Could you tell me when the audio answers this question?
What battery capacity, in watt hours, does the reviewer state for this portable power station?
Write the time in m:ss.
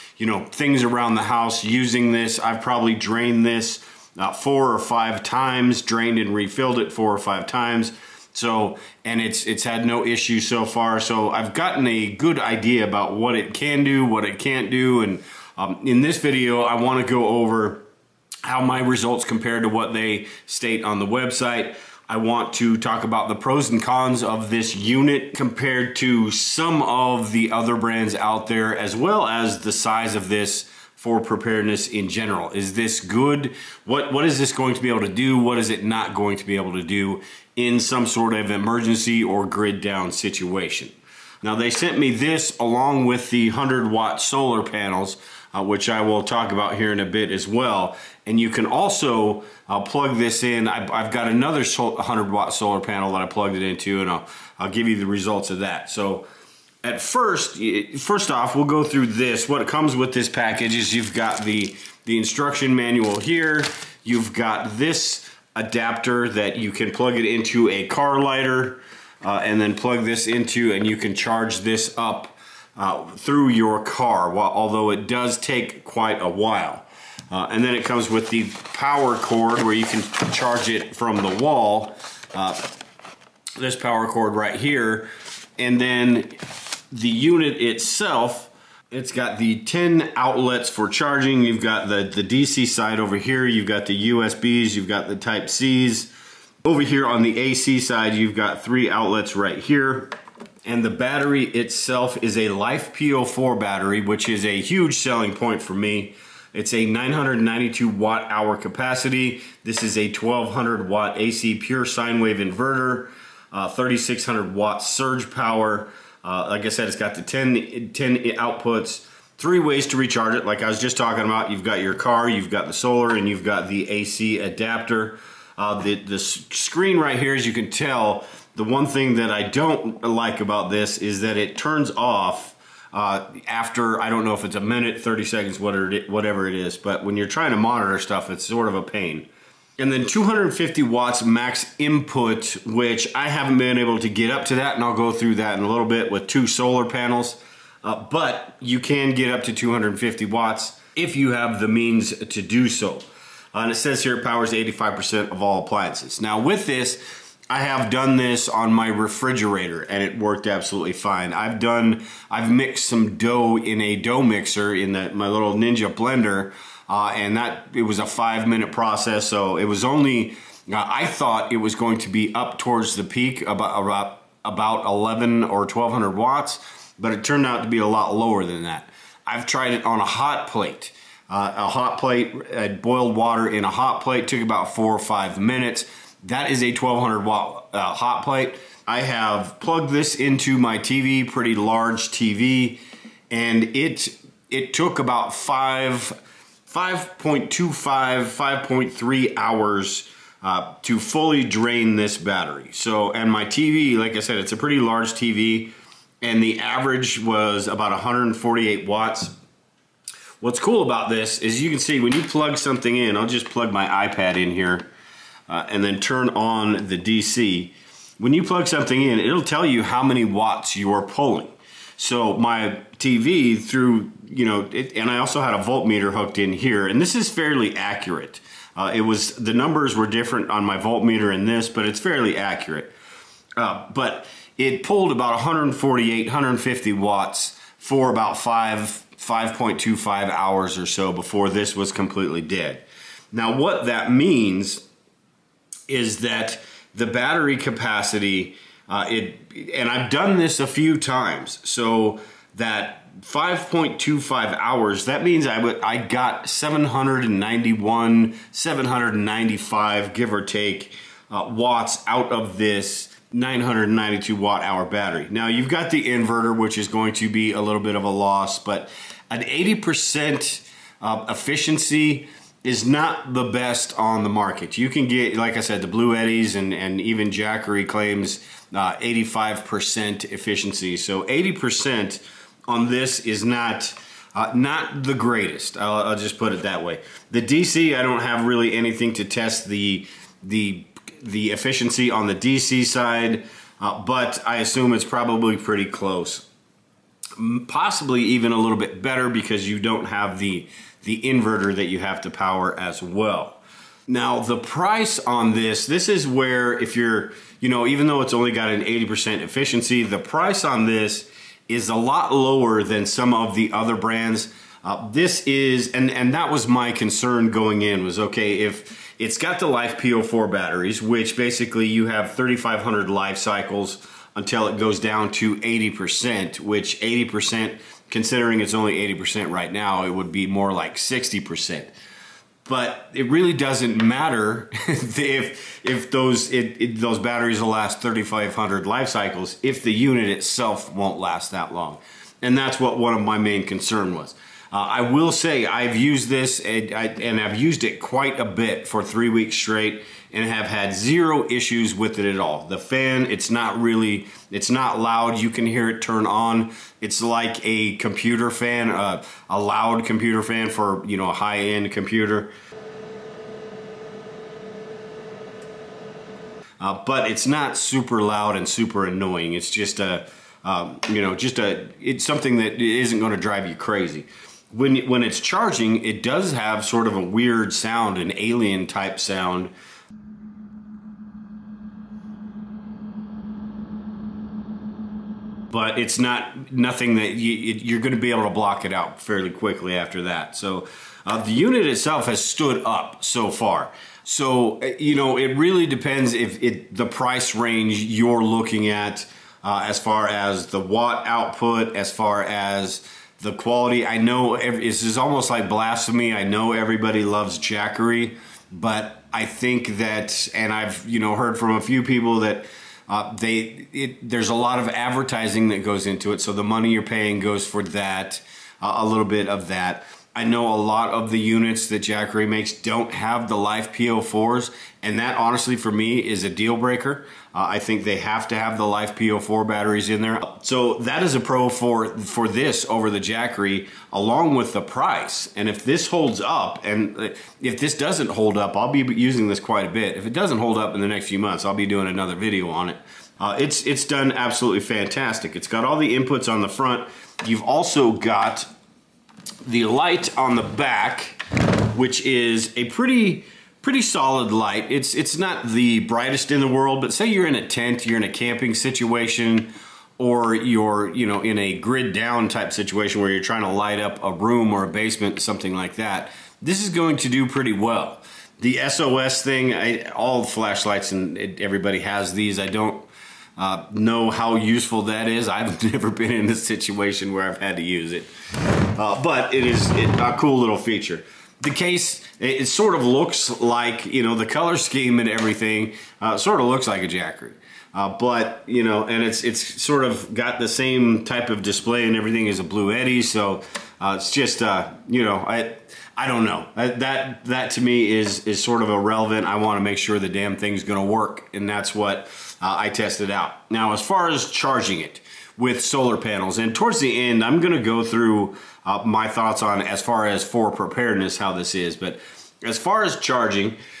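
1:46.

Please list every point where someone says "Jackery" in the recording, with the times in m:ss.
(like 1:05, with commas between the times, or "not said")
4:37, 6:47, 7:02, 7:13, 8:07.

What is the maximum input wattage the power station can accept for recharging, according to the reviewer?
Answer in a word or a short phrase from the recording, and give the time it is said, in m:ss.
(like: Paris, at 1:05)
250 watts, at 2:20.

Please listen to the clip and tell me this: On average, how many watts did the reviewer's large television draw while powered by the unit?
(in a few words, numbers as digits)
148 watts.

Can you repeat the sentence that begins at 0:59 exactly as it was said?
What comes with this package is you've got the, the instruction manual here.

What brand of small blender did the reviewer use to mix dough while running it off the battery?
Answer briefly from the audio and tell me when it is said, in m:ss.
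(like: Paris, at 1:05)
Ninja, at 2:45.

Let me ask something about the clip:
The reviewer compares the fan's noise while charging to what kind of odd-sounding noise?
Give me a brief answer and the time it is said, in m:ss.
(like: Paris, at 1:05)
alien type sound, at 6:18.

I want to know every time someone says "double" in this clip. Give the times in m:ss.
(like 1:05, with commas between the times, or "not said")
not said.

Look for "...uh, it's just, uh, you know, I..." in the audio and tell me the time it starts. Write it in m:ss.
8:13.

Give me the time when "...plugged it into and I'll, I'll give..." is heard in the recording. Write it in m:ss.
0:53.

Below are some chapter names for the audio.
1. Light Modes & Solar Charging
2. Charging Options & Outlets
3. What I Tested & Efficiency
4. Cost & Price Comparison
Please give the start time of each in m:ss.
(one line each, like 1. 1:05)
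1. 7:29
2. 1:00
3. 2:36
4. 5:03.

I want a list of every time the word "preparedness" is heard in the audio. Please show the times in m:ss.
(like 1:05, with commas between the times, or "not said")
0:31, 8:30.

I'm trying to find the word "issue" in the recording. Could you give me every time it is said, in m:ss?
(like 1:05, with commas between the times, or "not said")
0:10, 5:51.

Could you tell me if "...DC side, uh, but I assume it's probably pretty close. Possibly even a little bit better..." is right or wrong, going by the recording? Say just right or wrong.
right.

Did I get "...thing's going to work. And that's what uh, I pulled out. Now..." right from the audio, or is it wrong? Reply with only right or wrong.
wrong.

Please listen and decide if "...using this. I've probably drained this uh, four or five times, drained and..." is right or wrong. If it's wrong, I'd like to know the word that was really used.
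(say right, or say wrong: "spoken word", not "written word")
right.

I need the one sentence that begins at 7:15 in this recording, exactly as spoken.
And if this holds up, and uh, if this doesn't hold up, I'll be using this quite a bit.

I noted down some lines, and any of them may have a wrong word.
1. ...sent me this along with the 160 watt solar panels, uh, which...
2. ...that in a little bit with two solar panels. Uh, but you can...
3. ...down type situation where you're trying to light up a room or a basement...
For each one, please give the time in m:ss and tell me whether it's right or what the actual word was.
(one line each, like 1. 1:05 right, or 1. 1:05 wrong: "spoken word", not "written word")
1. 0:41 wrong: "100", not "160"
2. 2:25 right
3. 7:42 right.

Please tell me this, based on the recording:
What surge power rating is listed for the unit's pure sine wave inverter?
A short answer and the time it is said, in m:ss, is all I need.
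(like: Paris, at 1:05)
3600 watts, at 1:53.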